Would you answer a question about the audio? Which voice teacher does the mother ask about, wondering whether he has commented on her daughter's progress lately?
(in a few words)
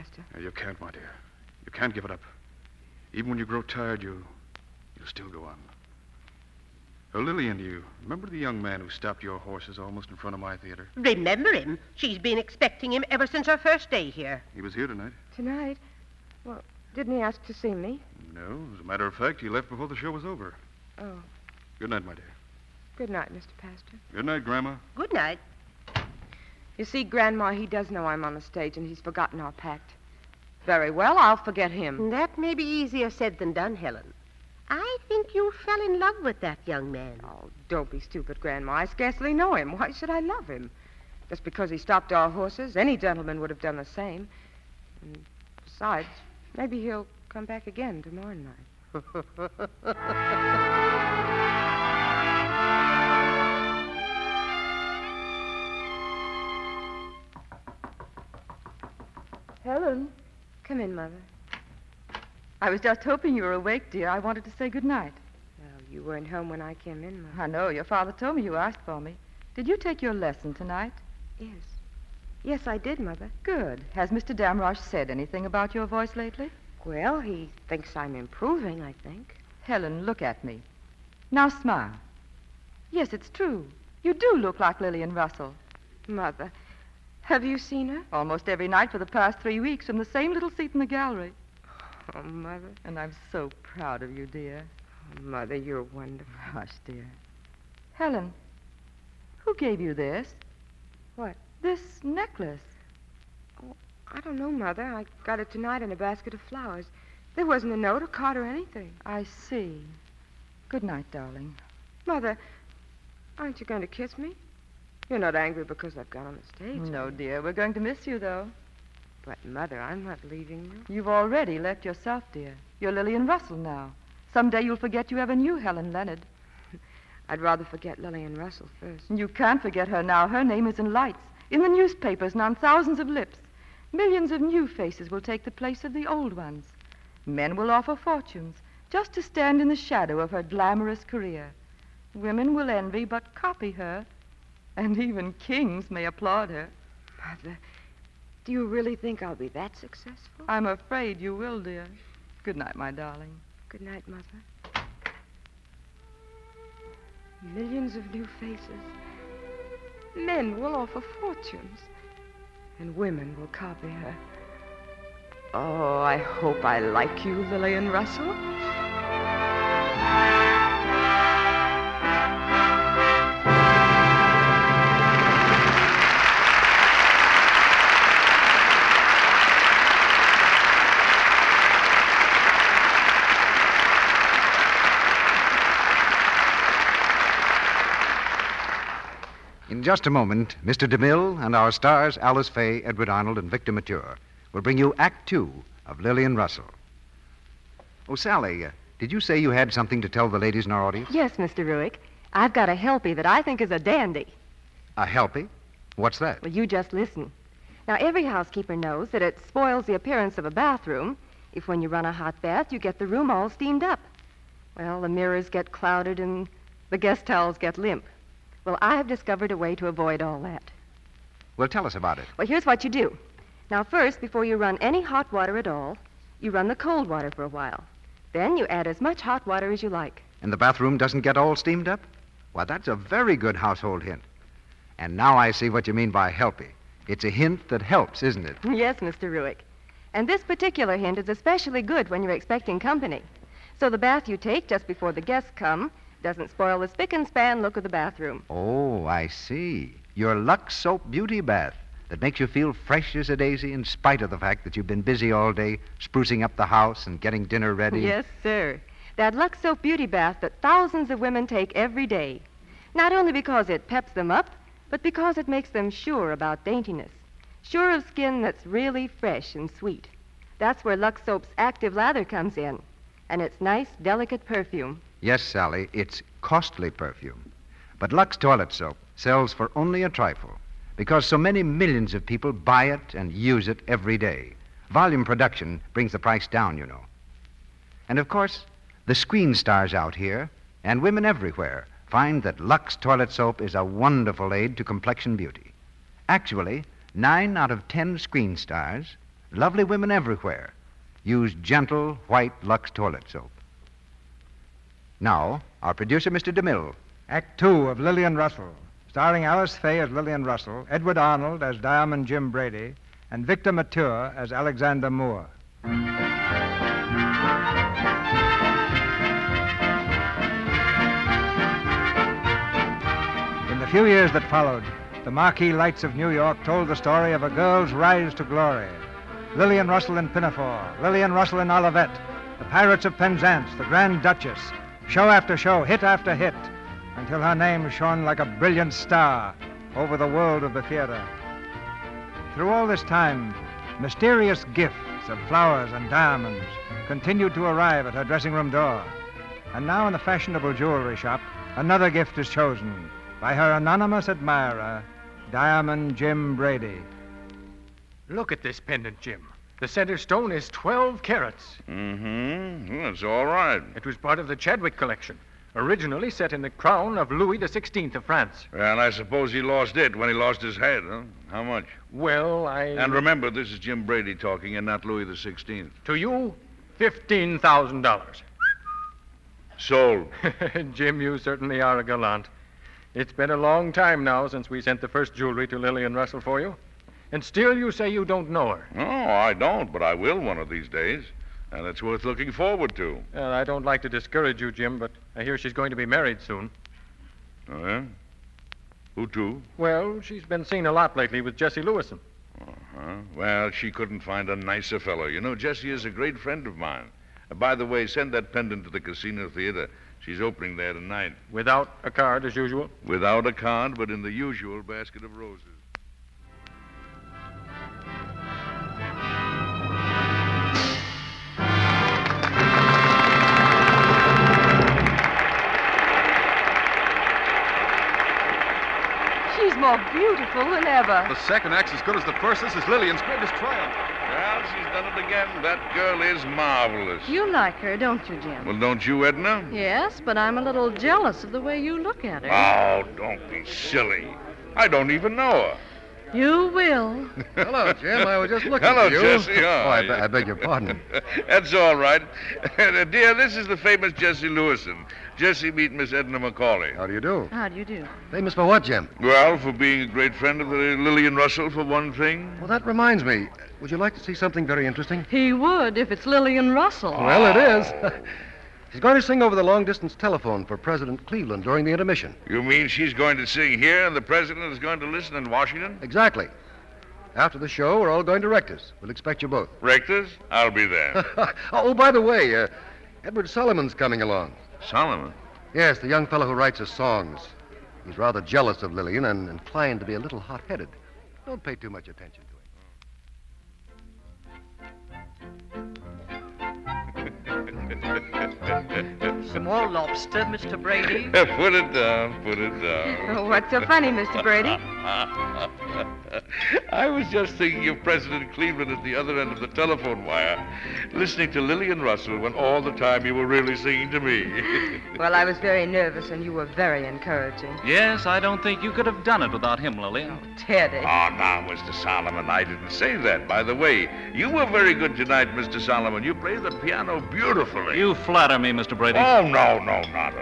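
Mr. Damrosch.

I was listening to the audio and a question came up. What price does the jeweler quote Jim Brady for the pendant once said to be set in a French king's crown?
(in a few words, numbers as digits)
$15,000.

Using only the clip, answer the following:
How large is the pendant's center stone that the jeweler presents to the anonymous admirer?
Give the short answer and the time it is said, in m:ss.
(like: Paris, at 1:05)
12 carats, at 6:00.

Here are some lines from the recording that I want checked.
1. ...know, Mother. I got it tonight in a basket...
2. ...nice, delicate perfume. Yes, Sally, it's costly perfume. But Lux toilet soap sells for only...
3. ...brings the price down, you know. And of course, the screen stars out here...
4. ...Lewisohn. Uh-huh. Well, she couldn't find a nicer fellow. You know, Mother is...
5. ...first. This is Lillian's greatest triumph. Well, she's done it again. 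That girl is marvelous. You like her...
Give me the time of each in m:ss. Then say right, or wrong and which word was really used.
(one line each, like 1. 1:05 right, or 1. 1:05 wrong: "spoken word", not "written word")
1. 1:44 right
2. 4:33 right
3. 4:45 right
4. 6:41 wrong: "Jesse", not "Mother"
5. 7:12 right.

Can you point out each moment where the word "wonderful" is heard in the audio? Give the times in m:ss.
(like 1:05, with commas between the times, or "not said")
1:35, 4:53.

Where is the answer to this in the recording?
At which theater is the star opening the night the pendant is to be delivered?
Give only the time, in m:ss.
6:49.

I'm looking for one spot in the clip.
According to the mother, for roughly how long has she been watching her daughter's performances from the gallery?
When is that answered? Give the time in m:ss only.
1:29.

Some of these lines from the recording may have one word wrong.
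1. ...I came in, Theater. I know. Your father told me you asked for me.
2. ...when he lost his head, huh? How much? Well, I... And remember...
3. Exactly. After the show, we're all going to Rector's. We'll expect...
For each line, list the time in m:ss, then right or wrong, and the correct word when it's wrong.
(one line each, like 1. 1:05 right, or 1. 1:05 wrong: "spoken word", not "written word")
1. 1:06 wrong: "Mother", not "Theater"
2. 6:10 right
3. 7:56 right.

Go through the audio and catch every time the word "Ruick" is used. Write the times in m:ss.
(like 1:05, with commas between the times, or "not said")
3:21, 3:59.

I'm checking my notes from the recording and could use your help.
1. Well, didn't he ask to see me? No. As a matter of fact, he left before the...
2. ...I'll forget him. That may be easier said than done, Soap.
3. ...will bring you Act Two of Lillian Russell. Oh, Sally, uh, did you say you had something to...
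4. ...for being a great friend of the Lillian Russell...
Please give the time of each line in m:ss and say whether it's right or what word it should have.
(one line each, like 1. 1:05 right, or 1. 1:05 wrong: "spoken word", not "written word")
1. 0:16 right
2. 0:31 wrong: "Helen", not "Soap"
3. 3:14 right
4. 7:39 right.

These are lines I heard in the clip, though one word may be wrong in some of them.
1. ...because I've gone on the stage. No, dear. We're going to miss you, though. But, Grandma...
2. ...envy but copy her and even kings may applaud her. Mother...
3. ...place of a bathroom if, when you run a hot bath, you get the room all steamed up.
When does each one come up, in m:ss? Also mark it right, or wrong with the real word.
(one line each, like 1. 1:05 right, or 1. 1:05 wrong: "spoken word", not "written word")
1. 1:55 wrong: "Mother", not "Grandma"
2. 2:22 right
3. 3:29 wrong: "appearance", not "place".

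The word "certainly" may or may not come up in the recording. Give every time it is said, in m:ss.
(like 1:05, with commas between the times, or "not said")
6:21.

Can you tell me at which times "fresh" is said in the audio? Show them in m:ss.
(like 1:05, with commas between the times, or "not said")
4:12, 4:29.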